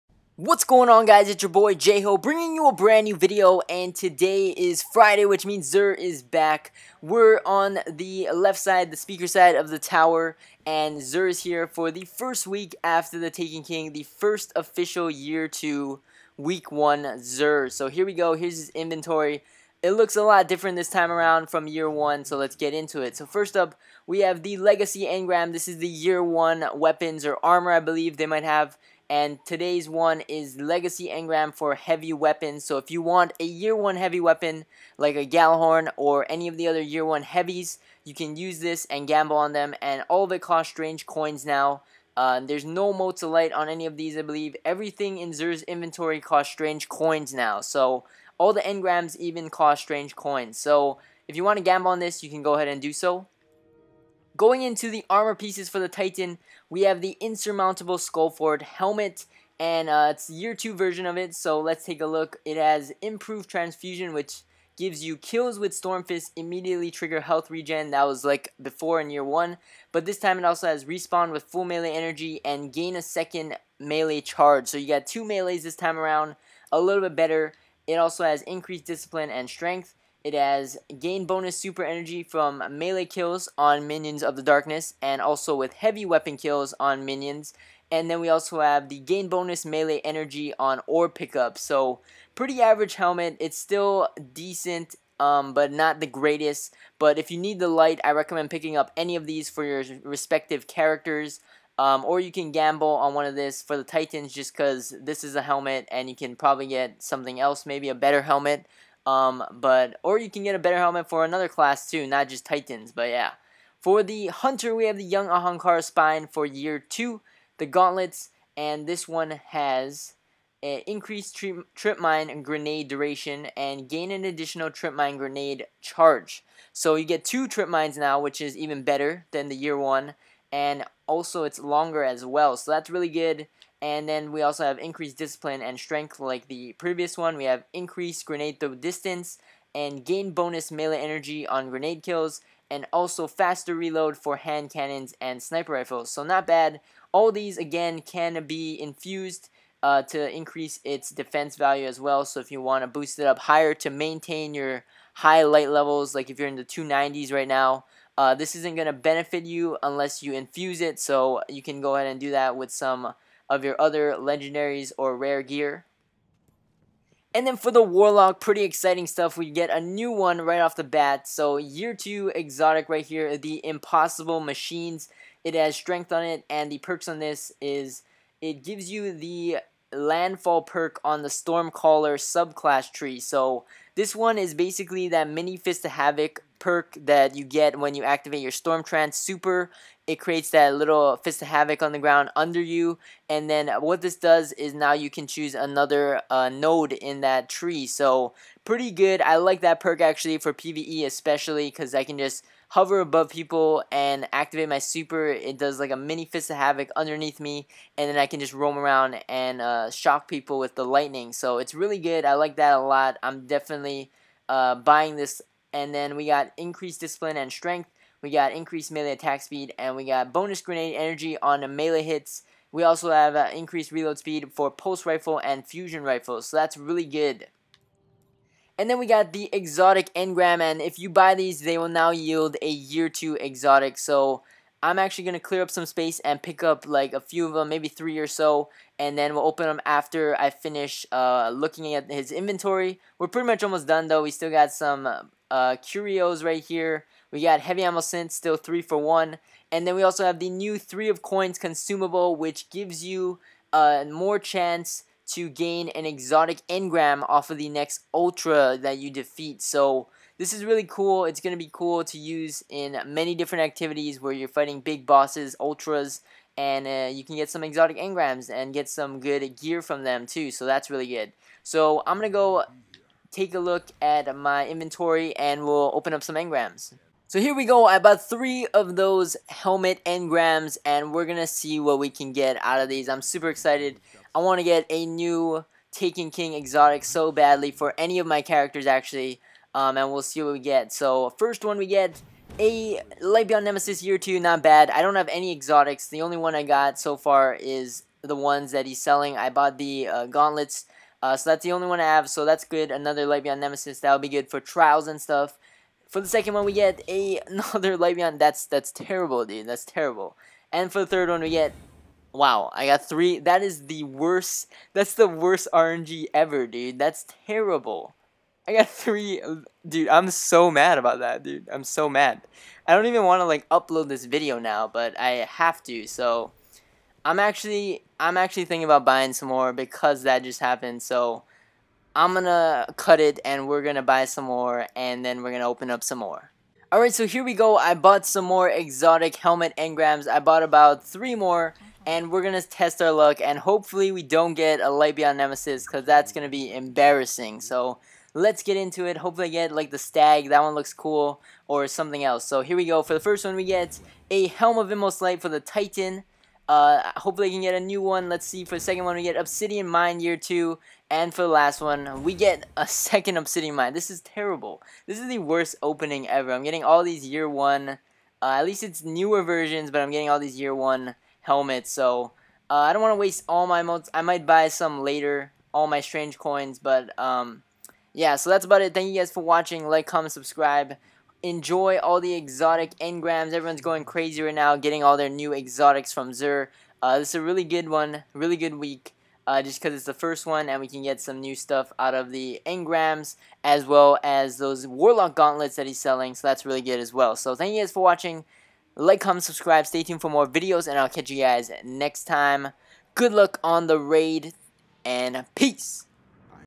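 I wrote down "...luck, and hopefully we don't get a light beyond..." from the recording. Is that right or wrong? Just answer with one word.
right.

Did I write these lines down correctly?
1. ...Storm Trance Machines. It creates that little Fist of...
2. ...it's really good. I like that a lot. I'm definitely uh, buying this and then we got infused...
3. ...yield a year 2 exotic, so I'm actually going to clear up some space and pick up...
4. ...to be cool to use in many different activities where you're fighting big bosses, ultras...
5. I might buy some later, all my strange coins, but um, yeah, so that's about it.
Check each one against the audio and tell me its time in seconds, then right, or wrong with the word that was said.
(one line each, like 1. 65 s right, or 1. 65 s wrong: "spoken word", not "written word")
1. 188 s wrong: "Super", not "Machines"
2. 211 s wrong: "increased", not "infused"
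3. 232 s right
4. 261 s right
5. 374 s right.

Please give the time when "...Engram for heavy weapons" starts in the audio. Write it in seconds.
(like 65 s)
31 s.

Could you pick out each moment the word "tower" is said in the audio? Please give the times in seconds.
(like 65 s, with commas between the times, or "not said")
9 s.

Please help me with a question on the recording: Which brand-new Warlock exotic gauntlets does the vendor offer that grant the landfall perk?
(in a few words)
Impossible Machines.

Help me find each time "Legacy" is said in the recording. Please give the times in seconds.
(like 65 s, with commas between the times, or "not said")
24 s, 30 s.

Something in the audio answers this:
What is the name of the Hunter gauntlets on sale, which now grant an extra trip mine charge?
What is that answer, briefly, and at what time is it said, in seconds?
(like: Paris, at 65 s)
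Young Ahamkara Spine, at 115 s.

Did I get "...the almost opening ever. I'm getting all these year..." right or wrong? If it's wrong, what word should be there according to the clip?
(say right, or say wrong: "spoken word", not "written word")
wrong: "worst", not "almost".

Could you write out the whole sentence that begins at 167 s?
And then for the Warlock, pretty exciting stuff.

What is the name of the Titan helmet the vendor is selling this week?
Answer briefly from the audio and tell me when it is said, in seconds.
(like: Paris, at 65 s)
Insurmountable Skullfort, at 57 s.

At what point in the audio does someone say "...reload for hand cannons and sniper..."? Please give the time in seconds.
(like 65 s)
143 s.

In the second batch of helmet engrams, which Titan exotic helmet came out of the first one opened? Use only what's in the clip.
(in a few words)
Helm of Inmost Light.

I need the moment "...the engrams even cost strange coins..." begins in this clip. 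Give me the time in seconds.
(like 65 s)
48 s.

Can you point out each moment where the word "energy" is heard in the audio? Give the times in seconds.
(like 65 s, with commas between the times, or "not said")
71 s, 81 s, 90 s, 141 s, 220 s.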